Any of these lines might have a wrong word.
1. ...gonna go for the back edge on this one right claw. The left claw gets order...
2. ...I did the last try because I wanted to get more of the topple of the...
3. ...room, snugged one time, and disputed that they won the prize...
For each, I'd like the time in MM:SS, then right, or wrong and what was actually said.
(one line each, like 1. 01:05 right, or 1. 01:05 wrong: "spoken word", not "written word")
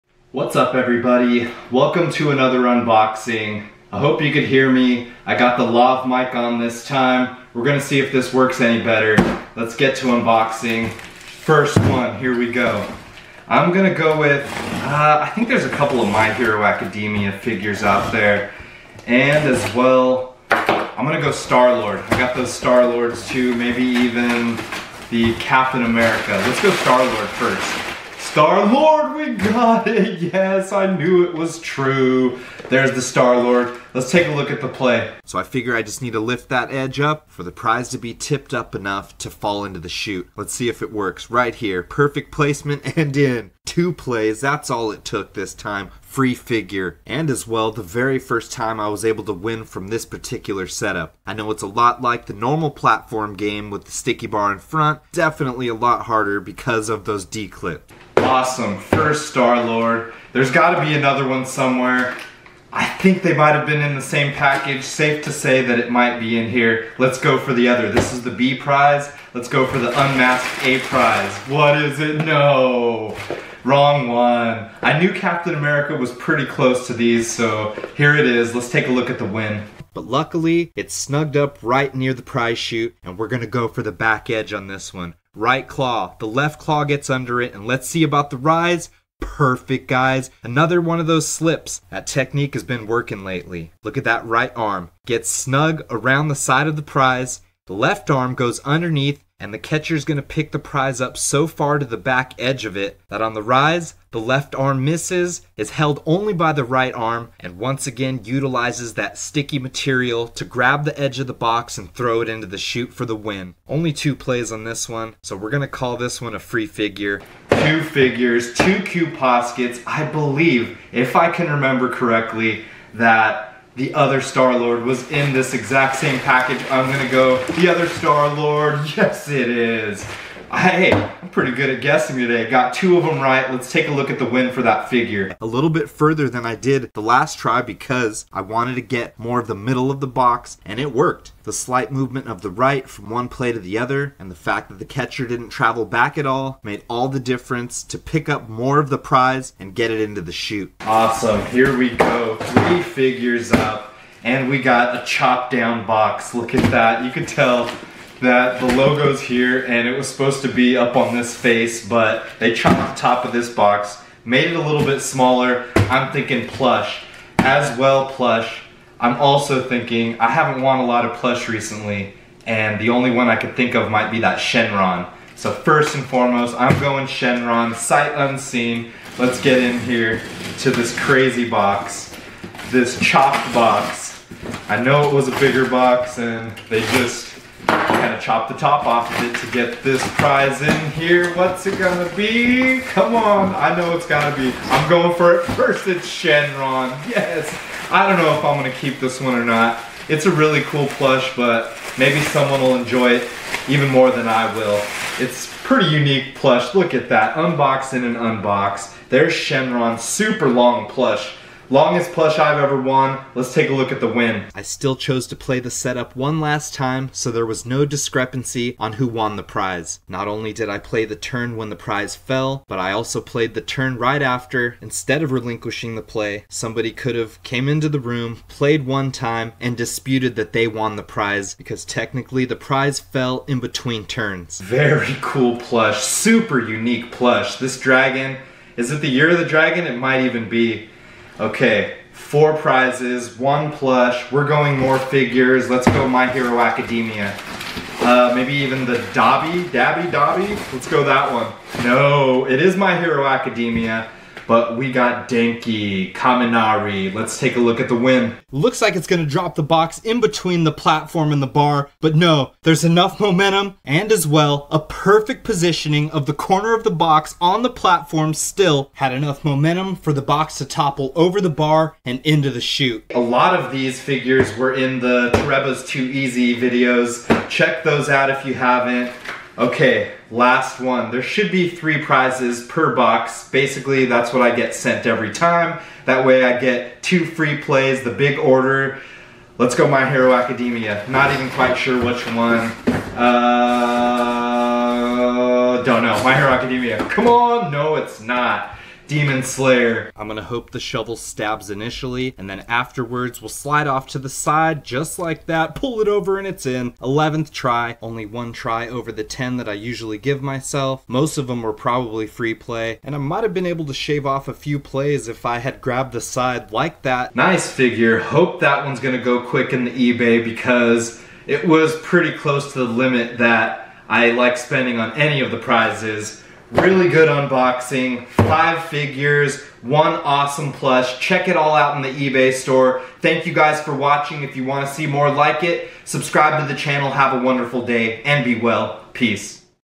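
1. 01:23 wrong: "under", not "order"
2. 02:16 wrong: "middle", not "topple"
3. 03:48 wrong: "played", not "snugged".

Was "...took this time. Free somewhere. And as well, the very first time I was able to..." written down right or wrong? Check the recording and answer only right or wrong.
wrong.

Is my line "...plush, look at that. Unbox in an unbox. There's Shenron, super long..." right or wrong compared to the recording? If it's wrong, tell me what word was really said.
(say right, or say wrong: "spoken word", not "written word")
right.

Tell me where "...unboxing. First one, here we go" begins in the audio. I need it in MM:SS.
00:10.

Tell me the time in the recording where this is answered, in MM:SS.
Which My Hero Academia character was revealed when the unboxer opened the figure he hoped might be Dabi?
04:15.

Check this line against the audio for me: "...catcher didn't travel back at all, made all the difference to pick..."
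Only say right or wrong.
right.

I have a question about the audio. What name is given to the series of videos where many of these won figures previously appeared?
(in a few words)
Toreba's Too Easy.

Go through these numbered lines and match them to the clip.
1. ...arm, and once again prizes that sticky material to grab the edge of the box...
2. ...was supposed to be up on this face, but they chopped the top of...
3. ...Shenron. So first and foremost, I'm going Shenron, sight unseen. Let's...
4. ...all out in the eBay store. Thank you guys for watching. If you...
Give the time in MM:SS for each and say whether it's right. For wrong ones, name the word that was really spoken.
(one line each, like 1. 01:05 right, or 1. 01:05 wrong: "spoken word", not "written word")
1. 01:46 wrong: "utilizes", not "prizes"
2. 02:39 right
3. 02:54 right
4. 05:31 right.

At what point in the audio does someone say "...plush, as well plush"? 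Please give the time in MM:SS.
02:46.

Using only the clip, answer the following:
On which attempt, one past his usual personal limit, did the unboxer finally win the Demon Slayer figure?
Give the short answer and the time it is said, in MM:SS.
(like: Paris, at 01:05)
11th, at 05:06.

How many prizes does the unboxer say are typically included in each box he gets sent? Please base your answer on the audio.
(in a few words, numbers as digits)
3.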